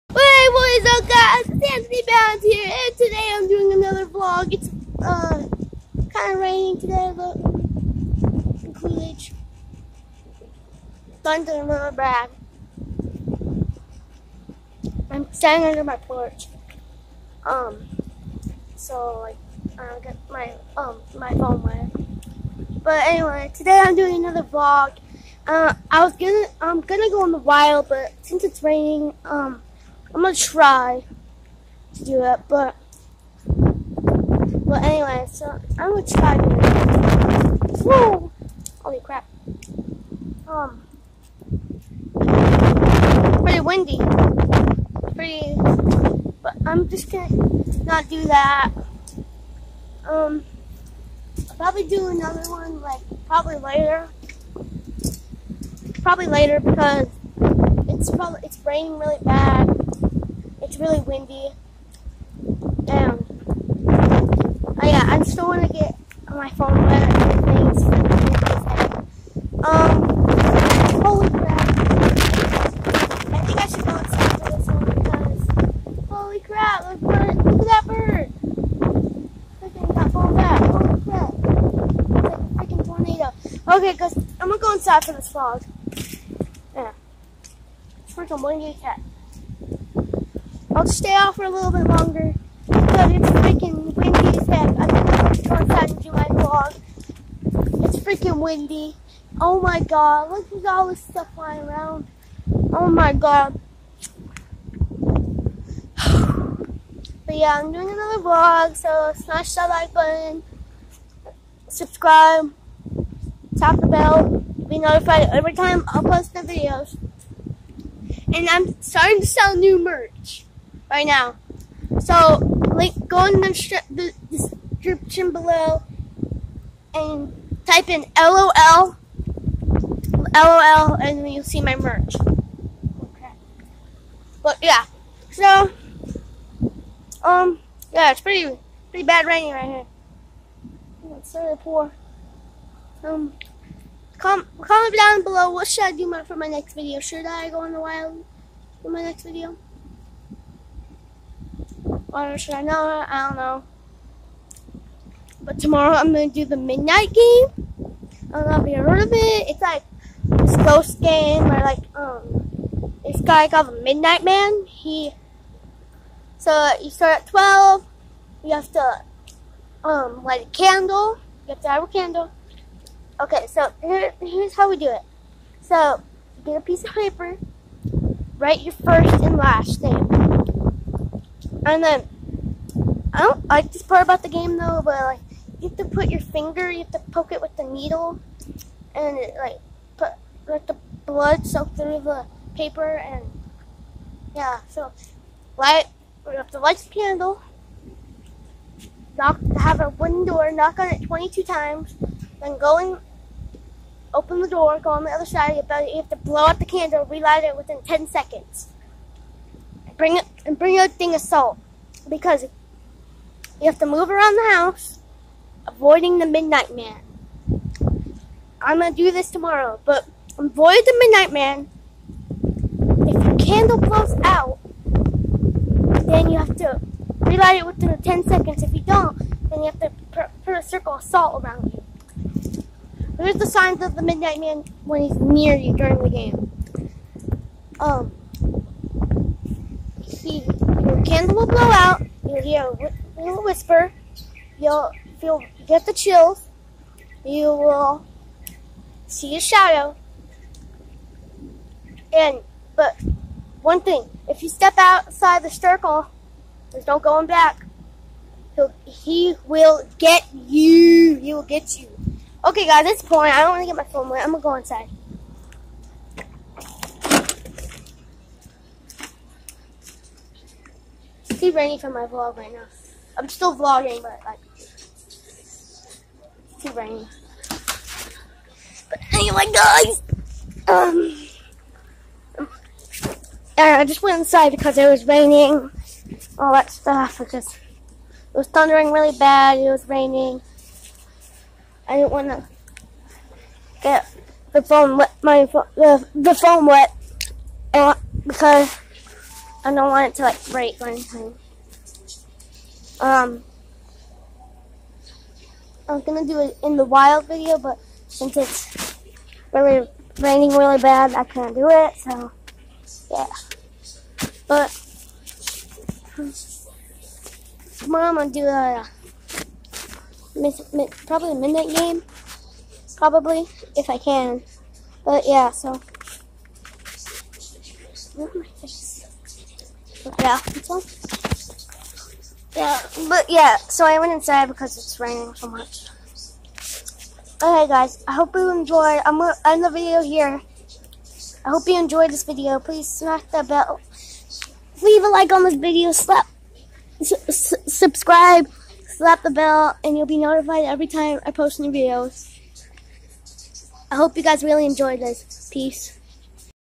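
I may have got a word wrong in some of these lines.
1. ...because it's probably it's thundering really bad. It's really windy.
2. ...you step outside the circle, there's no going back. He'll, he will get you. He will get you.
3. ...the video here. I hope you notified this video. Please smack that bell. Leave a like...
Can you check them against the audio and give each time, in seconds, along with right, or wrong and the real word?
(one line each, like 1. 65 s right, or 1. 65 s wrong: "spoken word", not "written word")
1. 56 s wrong: "raining", not "thundering"
2. 254 s right
3. 339 s wrong: "enjoyed", not "notified".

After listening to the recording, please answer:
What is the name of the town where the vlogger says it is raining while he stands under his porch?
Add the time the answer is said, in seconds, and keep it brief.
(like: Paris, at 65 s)
Coolidge, at 8 s.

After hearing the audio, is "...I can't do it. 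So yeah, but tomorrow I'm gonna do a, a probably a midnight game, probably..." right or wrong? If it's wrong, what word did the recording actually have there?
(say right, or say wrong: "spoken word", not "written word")
right.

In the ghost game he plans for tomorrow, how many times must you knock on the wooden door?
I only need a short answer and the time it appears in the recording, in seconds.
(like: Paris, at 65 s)
22, at 201 s.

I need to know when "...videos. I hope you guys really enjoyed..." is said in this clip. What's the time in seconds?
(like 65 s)
351 s.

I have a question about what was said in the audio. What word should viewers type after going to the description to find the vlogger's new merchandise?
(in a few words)
LOL.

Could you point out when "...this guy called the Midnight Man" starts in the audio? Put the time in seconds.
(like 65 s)
163 s.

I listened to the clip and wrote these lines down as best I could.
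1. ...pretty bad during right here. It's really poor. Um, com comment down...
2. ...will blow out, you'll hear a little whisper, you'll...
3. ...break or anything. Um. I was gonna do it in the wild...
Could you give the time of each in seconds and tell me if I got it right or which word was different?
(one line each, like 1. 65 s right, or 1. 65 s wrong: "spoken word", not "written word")
1. 138 s wrong: "raining", not "during"
2. 241 s right
3. 300 s right.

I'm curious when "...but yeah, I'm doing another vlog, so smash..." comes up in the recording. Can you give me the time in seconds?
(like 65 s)
105 s.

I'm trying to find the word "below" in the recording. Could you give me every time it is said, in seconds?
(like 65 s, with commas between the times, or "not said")
125 s, 145 s.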